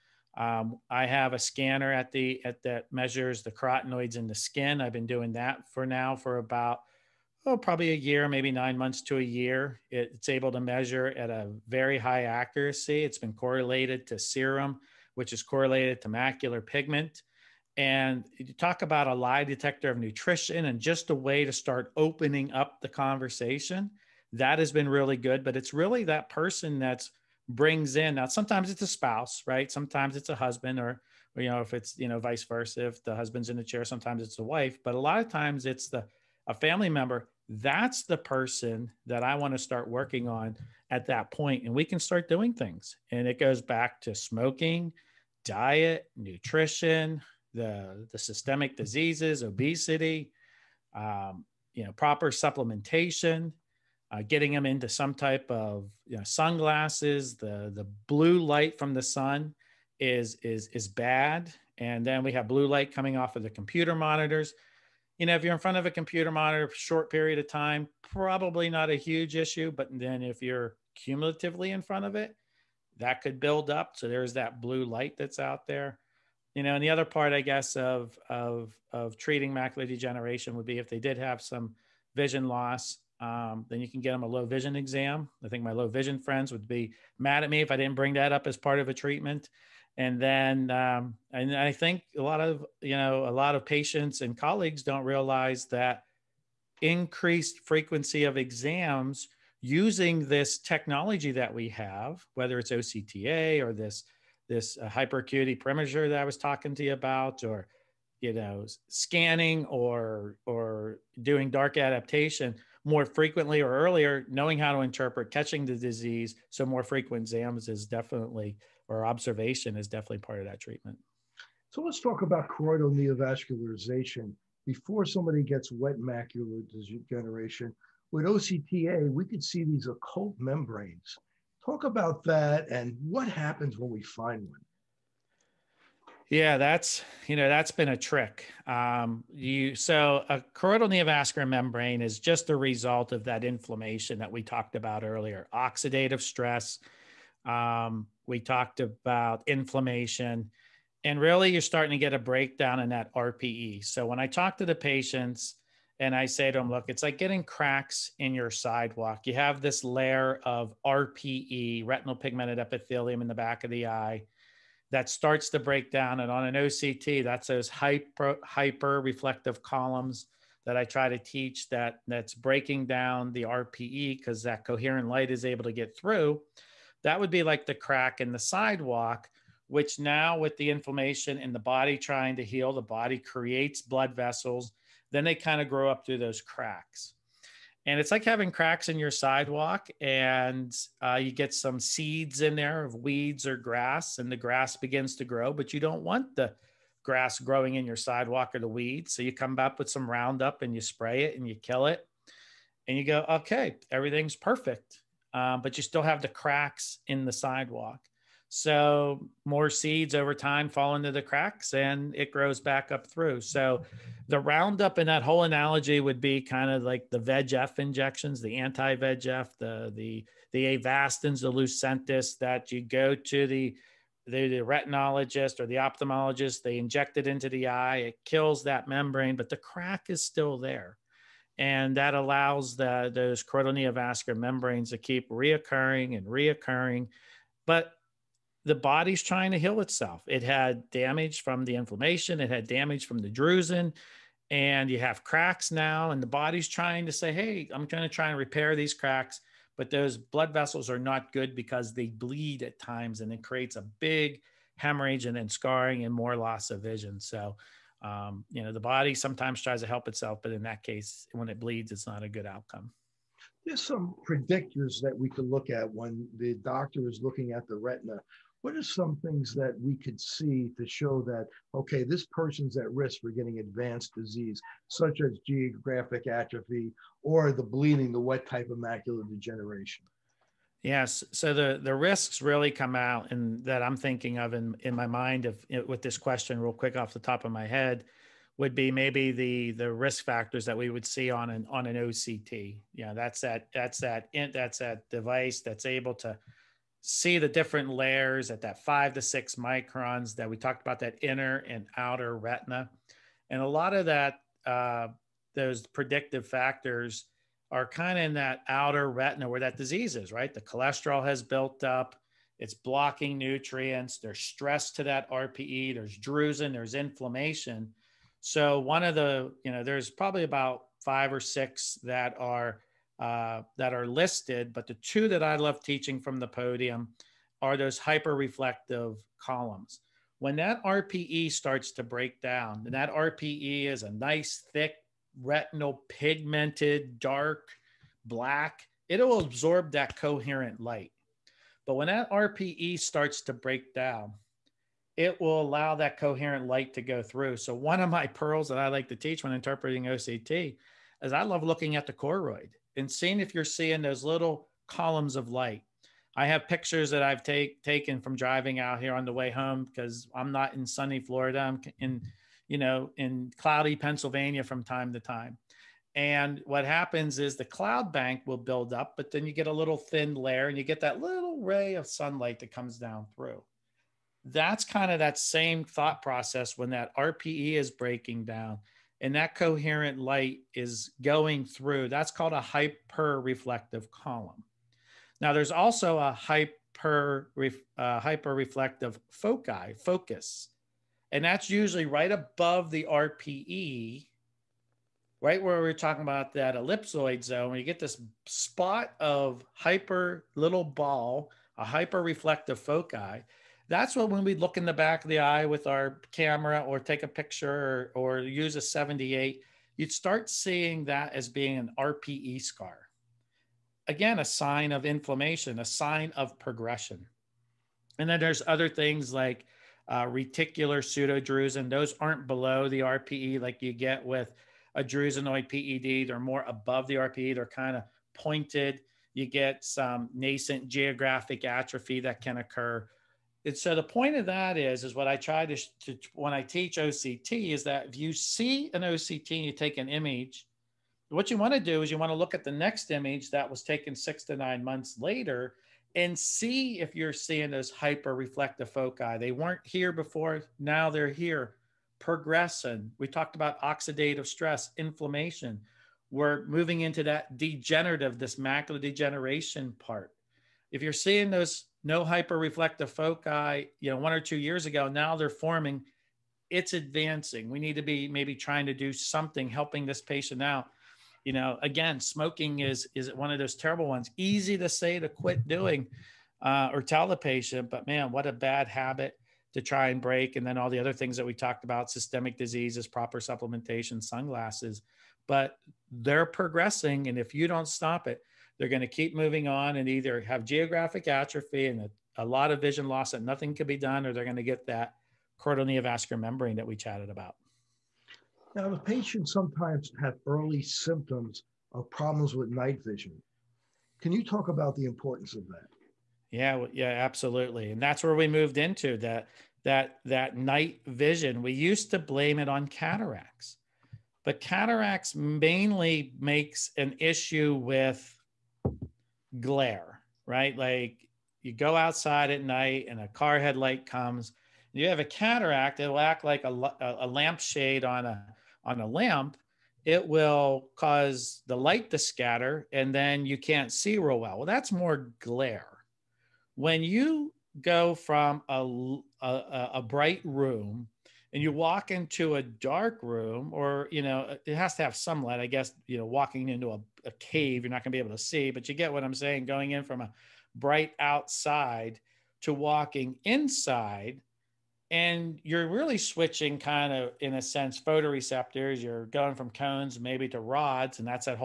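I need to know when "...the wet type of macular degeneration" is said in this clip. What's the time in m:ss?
4:38.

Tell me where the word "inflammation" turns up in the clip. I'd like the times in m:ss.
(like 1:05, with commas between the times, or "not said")
2:23, 2:29, 3:00, 4:01, 5:16, 6:55, 7:34.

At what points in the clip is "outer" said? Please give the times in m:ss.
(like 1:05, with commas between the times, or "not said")
5:01, 5:08.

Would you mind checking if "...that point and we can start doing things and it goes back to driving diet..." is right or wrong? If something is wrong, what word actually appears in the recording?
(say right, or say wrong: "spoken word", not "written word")
wrong: "smoking", not "driving".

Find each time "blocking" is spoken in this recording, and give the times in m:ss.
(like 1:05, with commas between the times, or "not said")
5:12.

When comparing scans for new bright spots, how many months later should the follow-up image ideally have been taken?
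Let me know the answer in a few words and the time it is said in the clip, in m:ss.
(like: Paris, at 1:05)
6 to 9 months, at 7:24.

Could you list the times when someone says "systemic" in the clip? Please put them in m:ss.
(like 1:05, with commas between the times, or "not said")
0:48, 8:02.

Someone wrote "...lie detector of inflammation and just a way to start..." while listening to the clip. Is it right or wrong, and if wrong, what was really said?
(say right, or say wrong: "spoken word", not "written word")
wrong: "nutrition", not "inflammation".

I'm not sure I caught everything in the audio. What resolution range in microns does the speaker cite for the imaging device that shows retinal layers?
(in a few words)
5 to 6 microns.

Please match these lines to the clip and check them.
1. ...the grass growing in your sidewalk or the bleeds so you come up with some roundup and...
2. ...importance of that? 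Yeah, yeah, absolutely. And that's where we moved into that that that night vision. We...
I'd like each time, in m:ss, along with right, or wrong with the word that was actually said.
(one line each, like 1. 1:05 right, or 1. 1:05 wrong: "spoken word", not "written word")
1. 3:16 wrong: "weeds", not "bleeds"
2. 8:25 right.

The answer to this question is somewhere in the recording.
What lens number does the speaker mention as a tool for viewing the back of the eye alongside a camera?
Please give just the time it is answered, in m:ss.
6:48.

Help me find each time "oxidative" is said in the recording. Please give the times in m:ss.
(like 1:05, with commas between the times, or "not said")
2:25, 7:33.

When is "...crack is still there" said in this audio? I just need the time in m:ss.
3:49.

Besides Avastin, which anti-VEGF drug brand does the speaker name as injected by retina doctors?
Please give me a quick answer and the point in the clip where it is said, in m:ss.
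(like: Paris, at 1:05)
Lucentis, at 3:41.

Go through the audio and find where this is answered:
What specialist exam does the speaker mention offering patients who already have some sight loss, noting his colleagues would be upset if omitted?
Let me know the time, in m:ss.
1:24.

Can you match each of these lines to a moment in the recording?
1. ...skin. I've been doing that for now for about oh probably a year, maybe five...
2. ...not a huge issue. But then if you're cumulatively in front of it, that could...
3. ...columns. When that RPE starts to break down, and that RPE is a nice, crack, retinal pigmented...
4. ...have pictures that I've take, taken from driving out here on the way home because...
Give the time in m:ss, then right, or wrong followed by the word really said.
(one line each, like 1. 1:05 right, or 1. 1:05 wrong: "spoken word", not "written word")
1. 0:04 wrong: "nine", not "five"
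2. 1:08 right
3. 5:29 wrong: "thick", not "crack"
4. 5:56 right.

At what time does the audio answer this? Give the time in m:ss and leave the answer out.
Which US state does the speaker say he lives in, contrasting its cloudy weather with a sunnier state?
6:03.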